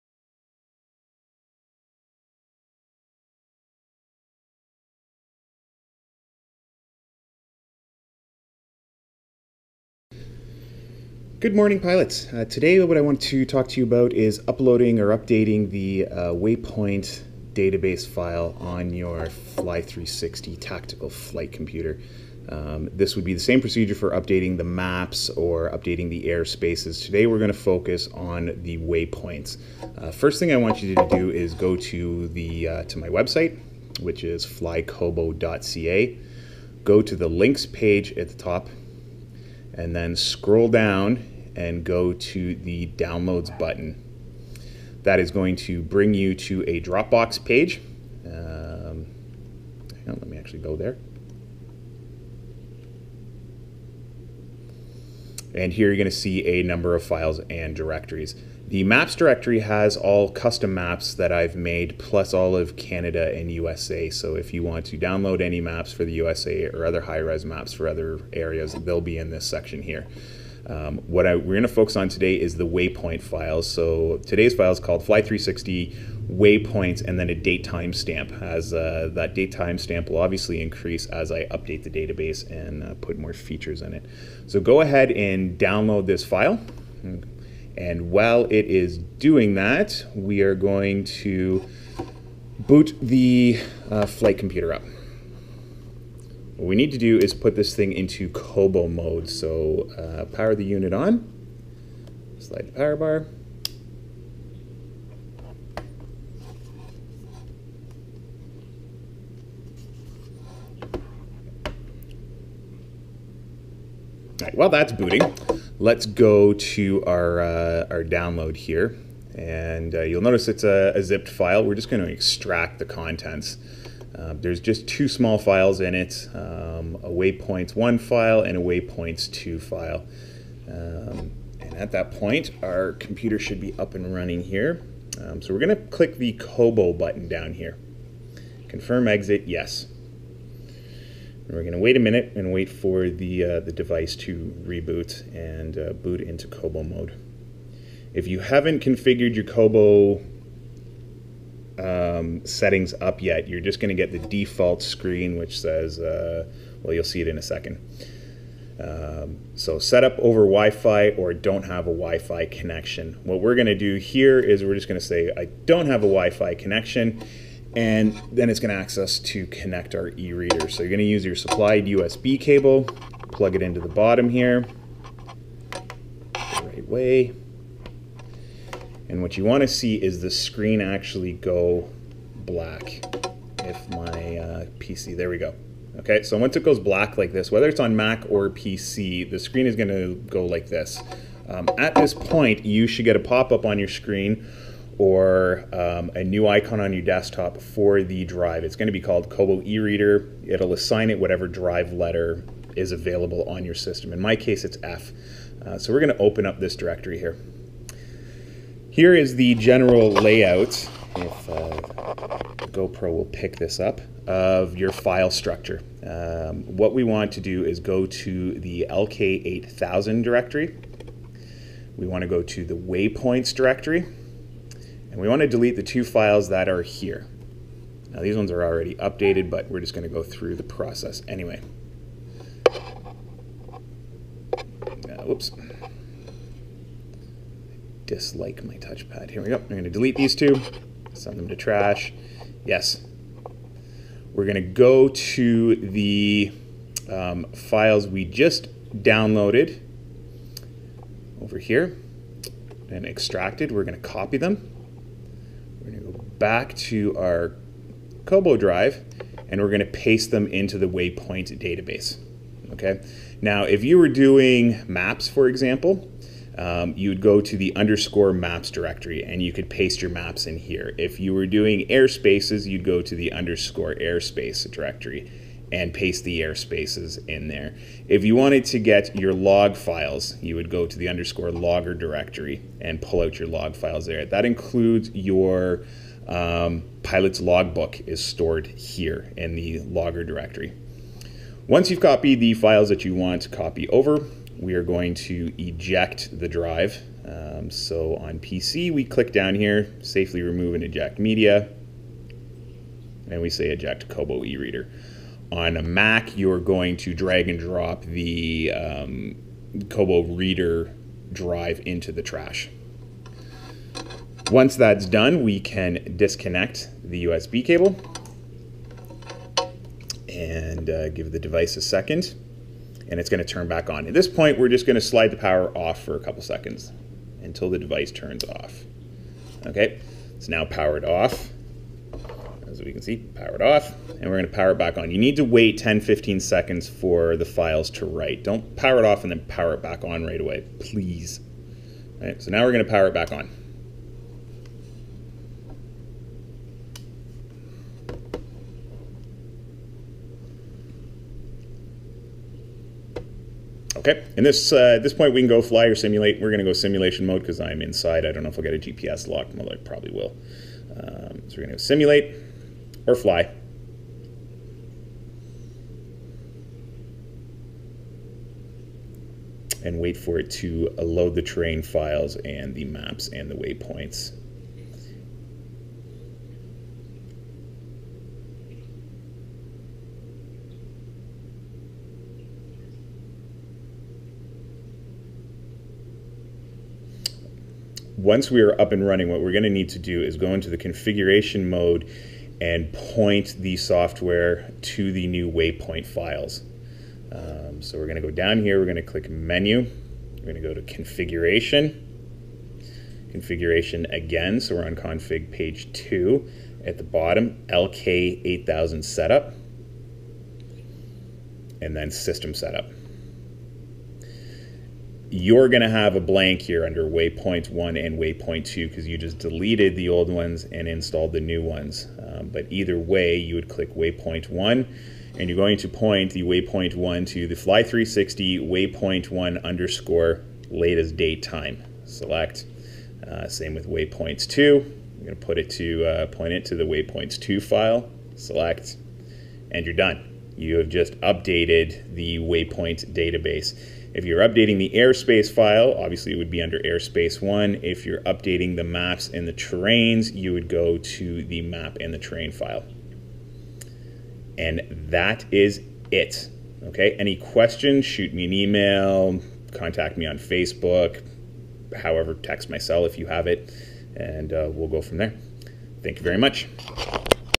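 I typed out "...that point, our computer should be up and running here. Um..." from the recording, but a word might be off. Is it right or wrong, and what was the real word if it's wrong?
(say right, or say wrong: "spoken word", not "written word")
right.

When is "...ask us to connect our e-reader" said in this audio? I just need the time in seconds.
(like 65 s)
168 s.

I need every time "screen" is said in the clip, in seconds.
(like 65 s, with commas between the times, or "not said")
154 s, 180 s, 189 s, 193 s.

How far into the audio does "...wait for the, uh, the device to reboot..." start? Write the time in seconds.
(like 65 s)
142 s.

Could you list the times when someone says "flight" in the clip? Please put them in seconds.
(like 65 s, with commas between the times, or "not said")
21 s, 94 s.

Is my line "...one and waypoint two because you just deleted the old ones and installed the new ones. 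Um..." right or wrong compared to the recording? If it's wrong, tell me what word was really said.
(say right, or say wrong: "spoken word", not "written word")
right.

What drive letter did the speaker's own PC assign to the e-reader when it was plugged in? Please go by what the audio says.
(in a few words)
F.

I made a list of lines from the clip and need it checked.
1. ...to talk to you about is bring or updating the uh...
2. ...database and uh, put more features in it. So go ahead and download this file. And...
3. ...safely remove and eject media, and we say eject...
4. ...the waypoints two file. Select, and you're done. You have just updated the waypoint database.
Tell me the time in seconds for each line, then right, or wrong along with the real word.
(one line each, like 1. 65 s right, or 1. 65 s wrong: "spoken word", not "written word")
1. 13 s wrong: "uploading", not "bring"
2. 81 s right
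3. 300 s right
4. 436 s right.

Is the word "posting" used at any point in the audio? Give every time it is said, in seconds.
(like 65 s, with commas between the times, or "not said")
not said.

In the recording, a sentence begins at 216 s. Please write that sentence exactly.
Um, what we want to do is go to the LK8000 directory.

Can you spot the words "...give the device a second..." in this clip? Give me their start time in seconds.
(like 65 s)
321 s.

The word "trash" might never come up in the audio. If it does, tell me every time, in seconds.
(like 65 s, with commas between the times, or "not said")
241 s, 312 s.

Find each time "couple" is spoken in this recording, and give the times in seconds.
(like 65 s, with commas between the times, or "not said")
326 s.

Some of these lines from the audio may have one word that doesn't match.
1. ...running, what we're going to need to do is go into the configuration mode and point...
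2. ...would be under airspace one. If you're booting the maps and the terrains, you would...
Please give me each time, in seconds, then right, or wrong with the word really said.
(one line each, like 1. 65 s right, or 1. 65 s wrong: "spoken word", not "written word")
1. 389 s right
2. 446 s wrong: "updating", not "booting".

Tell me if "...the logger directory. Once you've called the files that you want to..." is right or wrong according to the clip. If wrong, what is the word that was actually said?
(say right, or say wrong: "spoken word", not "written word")
wrong: "copied", not "called".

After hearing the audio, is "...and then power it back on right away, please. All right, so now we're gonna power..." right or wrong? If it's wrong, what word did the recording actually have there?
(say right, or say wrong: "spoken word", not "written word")
right.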